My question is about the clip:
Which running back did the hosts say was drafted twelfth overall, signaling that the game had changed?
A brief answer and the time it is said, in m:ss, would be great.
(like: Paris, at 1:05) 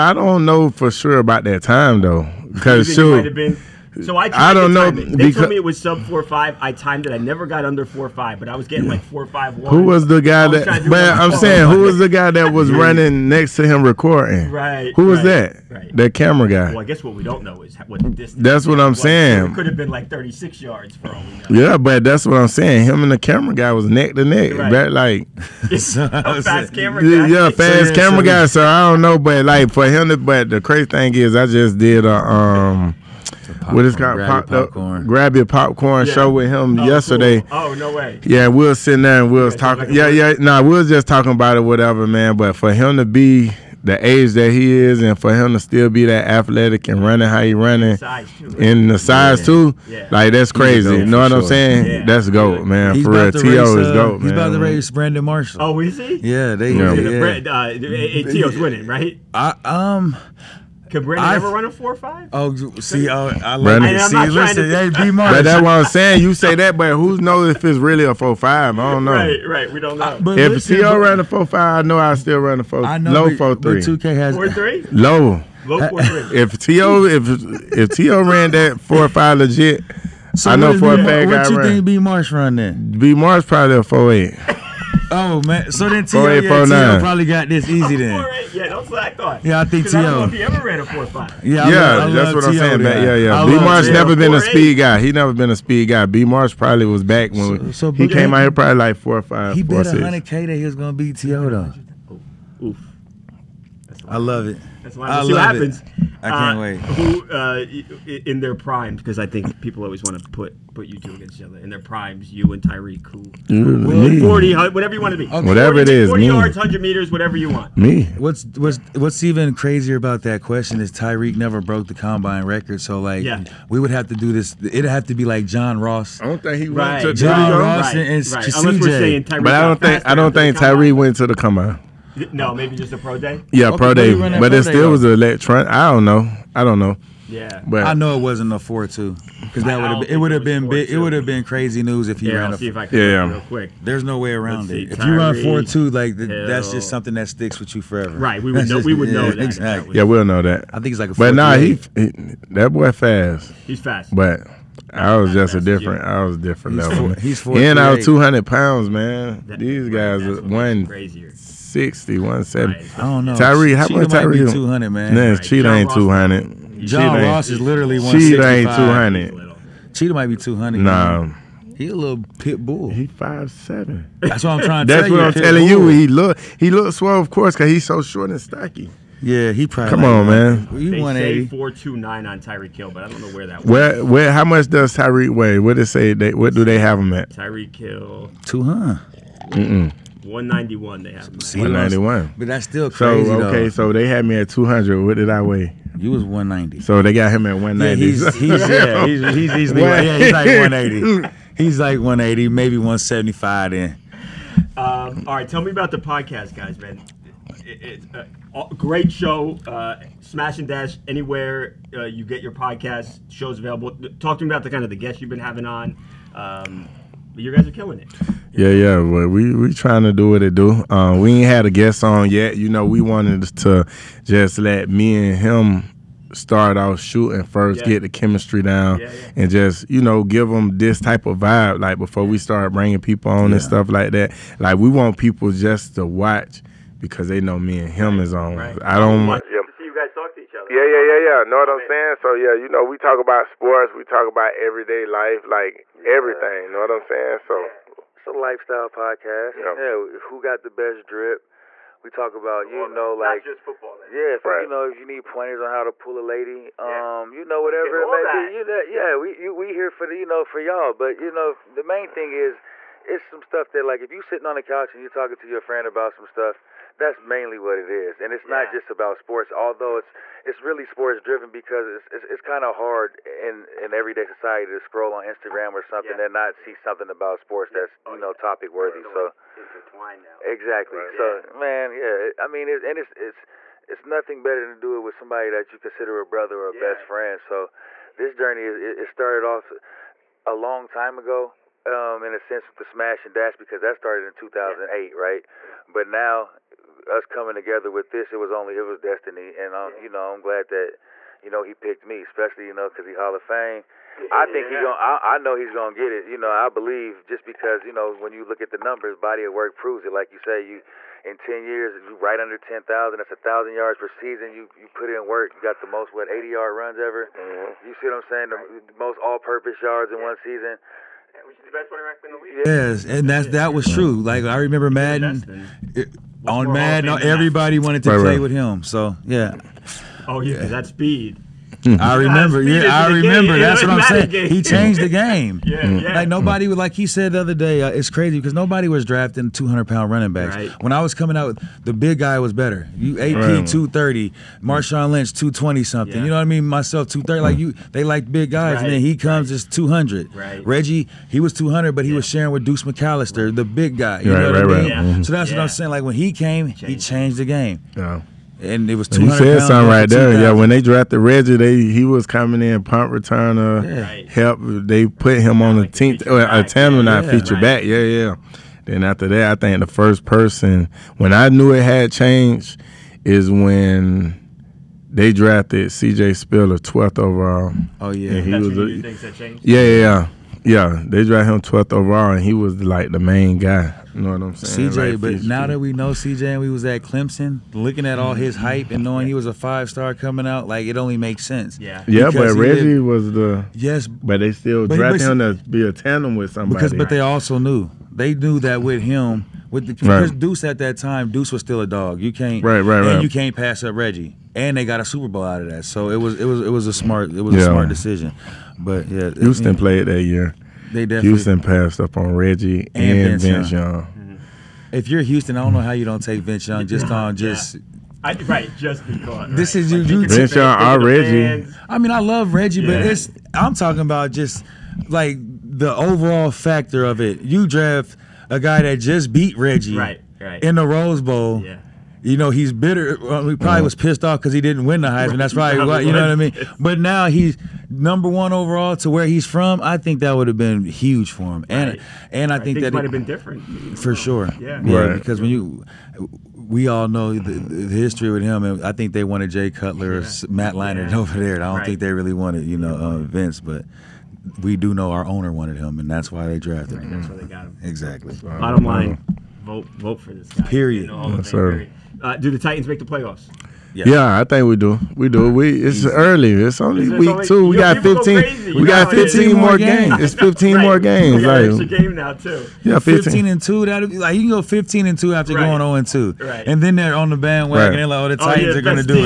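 C.J. Spiller, at 6:15.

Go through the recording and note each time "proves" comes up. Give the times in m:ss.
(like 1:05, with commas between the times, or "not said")
5:09.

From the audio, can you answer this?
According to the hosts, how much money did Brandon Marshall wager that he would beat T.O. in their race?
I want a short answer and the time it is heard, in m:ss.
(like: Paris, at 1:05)
100k, at 1:39.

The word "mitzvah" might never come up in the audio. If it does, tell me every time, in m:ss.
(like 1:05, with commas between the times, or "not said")
not said.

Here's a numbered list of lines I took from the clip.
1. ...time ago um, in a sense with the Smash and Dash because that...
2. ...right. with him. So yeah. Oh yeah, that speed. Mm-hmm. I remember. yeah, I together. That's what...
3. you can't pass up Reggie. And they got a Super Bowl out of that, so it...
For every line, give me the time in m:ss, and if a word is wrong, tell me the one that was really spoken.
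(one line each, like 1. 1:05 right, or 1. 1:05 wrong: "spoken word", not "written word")
1. 4:50 right
2. 5:28 wrong: "remember", not "together"
3. 6:43 right.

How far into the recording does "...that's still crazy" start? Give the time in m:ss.
3:12.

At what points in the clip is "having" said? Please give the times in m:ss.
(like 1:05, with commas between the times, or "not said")
3:35.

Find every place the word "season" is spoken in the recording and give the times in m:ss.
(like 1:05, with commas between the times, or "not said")
5:14, 5:20.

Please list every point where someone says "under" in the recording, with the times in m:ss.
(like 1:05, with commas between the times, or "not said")
0:07, 5:12.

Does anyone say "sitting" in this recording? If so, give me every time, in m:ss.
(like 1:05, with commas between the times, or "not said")
0:38, 4:24.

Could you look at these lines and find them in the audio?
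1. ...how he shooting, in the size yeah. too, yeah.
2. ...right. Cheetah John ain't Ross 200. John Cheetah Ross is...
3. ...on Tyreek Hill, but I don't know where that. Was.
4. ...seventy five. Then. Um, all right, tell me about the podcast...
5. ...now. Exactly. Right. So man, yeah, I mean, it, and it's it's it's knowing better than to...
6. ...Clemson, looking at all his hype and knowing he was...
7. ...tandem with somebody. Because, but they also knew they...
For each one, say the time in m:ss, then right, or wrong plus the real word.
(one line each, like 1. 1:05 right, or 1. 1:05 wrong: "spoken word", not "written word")
1. 0:47 wrong: "running", not "shooting"
2. 2:45 right
3. 3:02 right
4. 3:22 right
5. 4:40 wrong: "nothing", not "knowing"
6. 6:27 right
7. 6:35 right.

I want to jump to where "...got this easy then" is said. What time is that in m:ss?
1:27.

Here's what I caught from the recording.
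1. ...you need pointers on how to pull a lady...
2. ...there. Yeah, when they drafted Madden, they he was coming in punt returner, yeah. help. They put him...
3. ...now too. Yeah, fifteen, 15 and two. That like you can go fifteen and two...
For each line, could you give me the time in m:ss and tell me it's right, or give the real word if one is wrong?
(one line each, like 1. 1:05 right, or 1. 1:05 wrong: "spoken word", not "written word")
1. 4:14 right
2. 6:00 wrong: "Reggie", not "Madden"
3. 7:52 right.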